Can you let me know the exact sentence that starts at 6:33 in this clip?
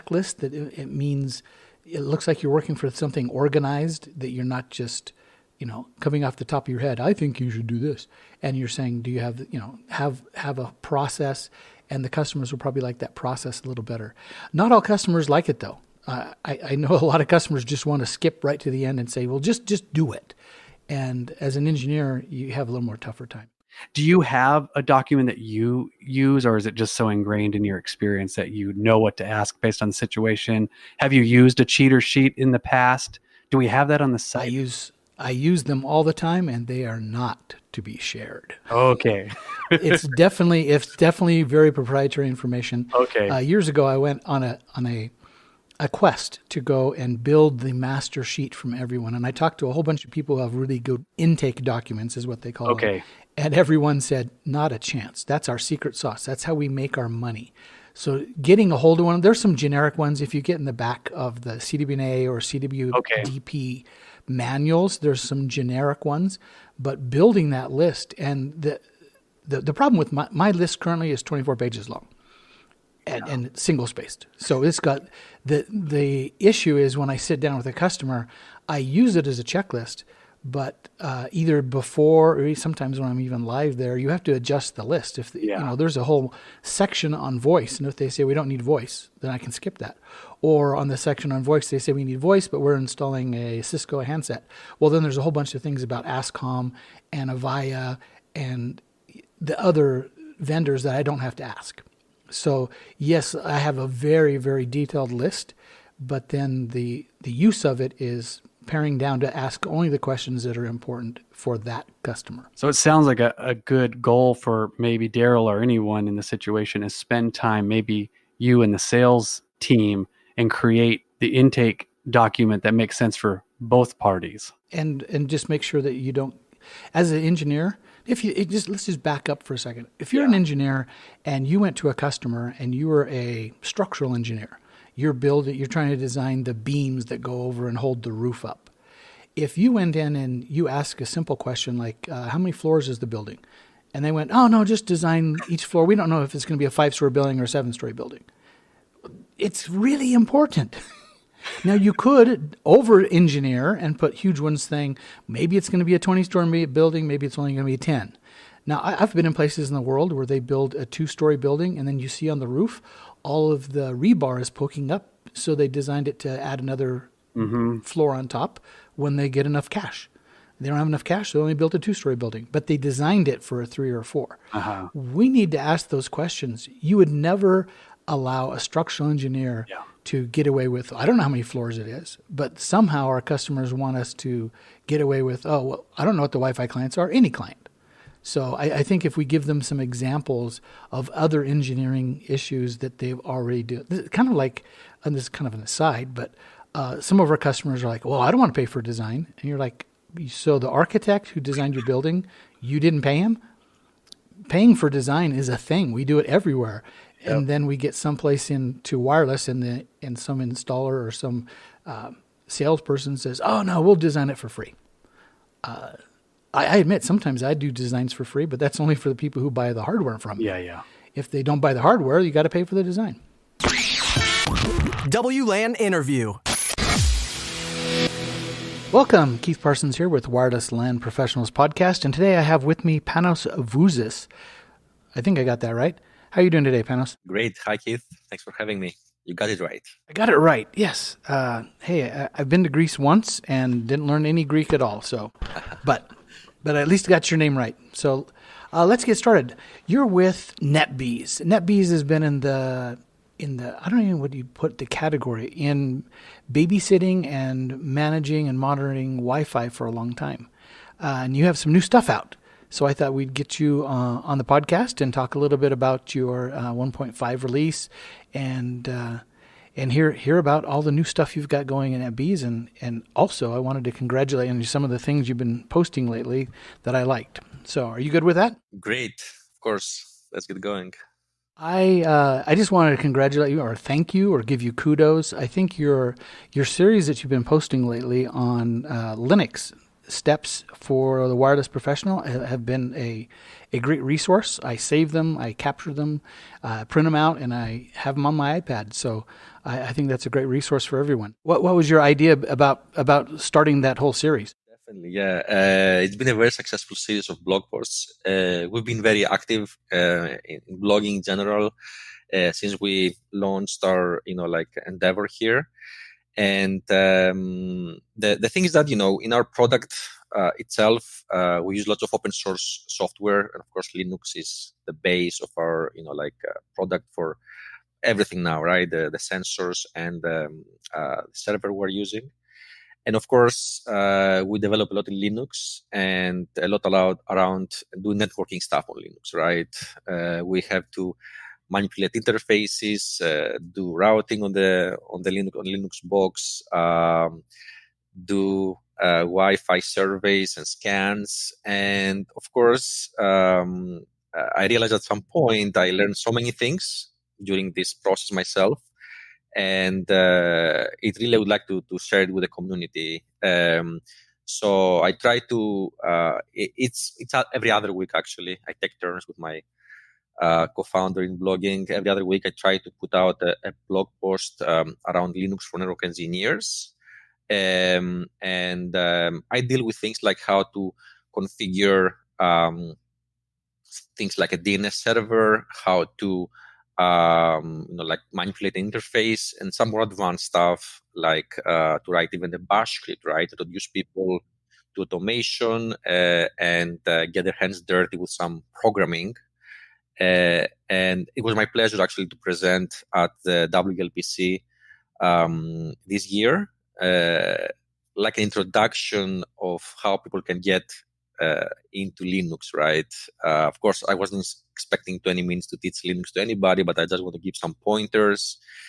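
To use people to automation uh, and uh, get their hands dirty with some programming.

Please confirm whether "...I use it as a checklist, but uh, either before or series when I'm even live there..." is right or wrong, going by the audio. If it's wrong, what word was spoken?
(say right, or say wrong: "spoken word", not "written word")
wrong: "sometimes", not "series".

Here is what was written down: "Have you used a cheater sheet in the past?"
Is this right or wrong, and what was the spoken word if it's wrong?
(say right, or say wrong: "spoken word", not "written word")
right.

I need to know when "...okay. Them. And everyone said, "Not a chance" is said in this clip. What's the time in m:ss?
0:52.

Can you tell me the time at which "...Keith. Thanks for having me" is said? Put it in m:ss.
3:57.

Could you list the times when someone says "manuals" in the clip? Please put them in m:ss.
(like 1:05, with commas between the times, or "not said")
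1:04.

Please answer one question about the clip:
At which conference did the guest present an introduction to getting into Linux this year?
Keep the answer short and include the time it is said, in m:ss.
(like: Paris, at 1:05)
WLPC, at 6:43.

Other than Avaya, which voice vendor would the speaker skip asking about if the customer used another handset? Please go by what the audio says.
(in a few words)
Ascom.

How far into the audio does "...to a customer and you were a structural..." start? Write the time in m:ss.
2:11.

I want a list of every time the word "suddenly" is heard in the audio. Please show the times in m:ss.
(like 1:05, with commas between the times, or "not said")
not said.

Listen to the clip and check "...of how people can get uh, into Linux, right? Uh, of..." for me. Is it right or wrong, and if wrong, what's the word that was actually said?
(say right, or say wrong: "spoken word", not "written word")
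right.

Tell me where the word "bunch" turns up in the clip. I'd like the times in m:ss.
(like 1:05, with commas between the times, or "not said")
0:49, 1:35.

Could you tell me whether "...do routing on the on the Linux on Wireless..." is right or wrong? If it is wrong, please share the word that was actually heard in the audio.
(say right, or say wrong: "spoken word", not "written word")
wrong: "Linux", not "Wireless".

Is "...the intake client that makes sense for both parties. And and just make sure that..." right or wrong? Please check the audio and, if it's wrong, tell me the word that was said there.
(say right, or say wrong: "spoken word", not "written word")
wrong: "document", not "client".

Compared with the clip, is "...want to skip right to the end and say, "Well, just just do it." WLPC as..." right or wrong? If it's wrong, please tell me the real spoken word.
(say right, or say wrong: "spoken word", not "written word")
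wrong: "And", not "WLPC".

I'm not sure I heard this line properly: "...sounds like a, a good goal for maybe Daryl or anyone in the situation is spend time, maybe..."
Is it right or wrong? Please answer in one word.
right.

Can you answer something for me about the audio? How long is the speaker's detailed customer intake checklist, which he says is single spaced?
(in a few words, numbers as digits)
24 pages.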